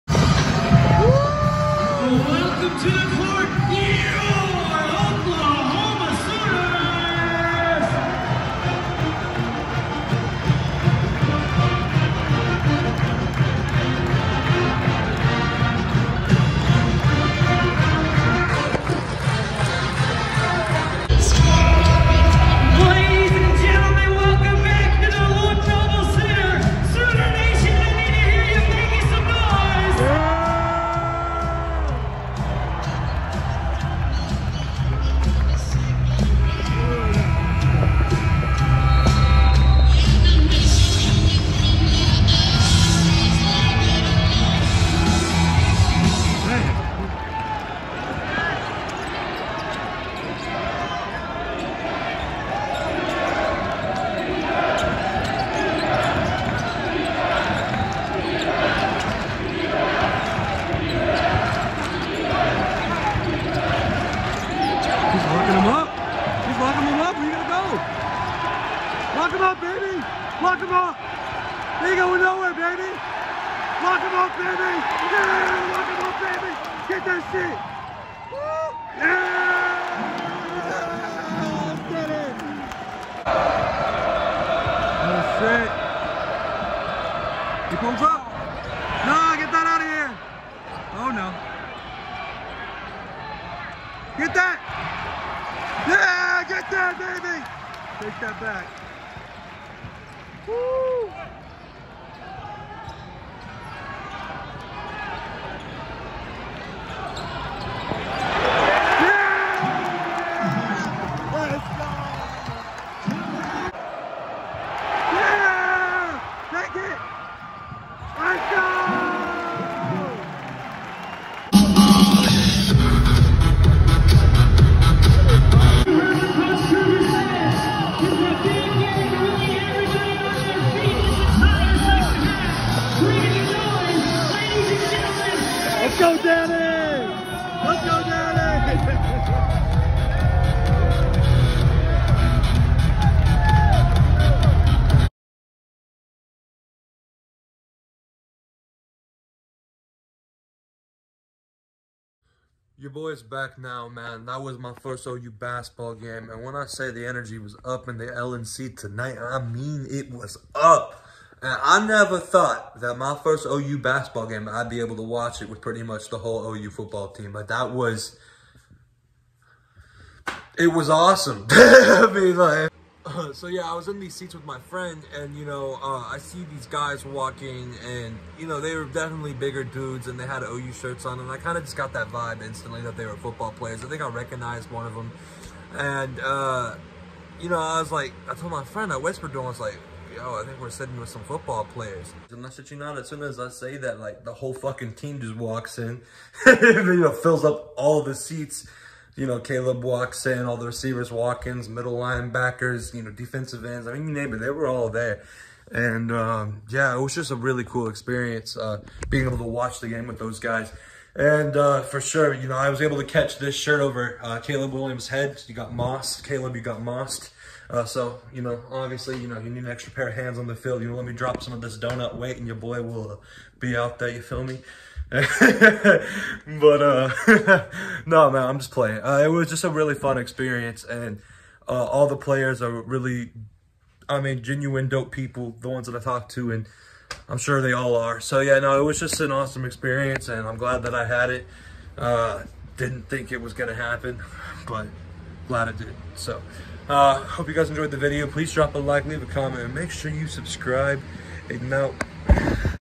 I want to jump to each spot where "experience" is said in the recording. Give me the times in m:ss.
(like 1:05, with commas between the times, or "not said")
3:27, 3:50, 3:59.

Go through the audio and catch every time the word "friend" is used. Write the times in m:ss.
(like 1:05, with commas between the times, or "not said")
2:54, 3:08.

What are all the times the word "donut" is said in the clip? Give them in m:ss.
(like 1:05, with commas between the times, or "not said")
3:41.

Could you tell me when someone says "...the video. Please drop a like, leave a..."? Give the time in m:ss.
4:07.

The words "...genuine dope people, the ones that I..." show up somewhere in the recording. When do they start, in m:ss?
3:54.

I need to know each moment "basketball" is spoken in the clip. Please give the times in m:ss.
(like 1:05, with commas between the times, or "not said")
2:35, 2:43.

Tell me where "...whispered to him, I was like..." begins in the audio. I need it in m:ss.
3:08.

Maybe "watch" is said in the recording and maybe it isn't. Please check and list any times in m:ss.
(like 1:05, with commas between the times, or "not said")
2:45, 3:29.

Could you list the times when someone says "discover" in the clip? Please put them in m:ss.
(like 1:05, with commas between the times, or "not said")
not said.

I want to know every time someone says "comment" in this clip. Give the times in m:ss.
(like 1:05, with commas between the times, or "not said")
4:09.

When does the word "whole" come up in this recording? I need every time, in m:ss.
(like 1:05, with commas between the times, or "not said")
2:46, 3:14.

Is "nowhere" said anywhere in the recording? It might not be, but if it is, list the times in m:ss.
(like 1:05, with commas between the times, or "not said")
1:12.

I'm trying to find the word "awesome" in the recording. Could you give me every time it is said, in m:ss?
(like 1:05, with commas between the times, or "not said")
2:50, 3:59.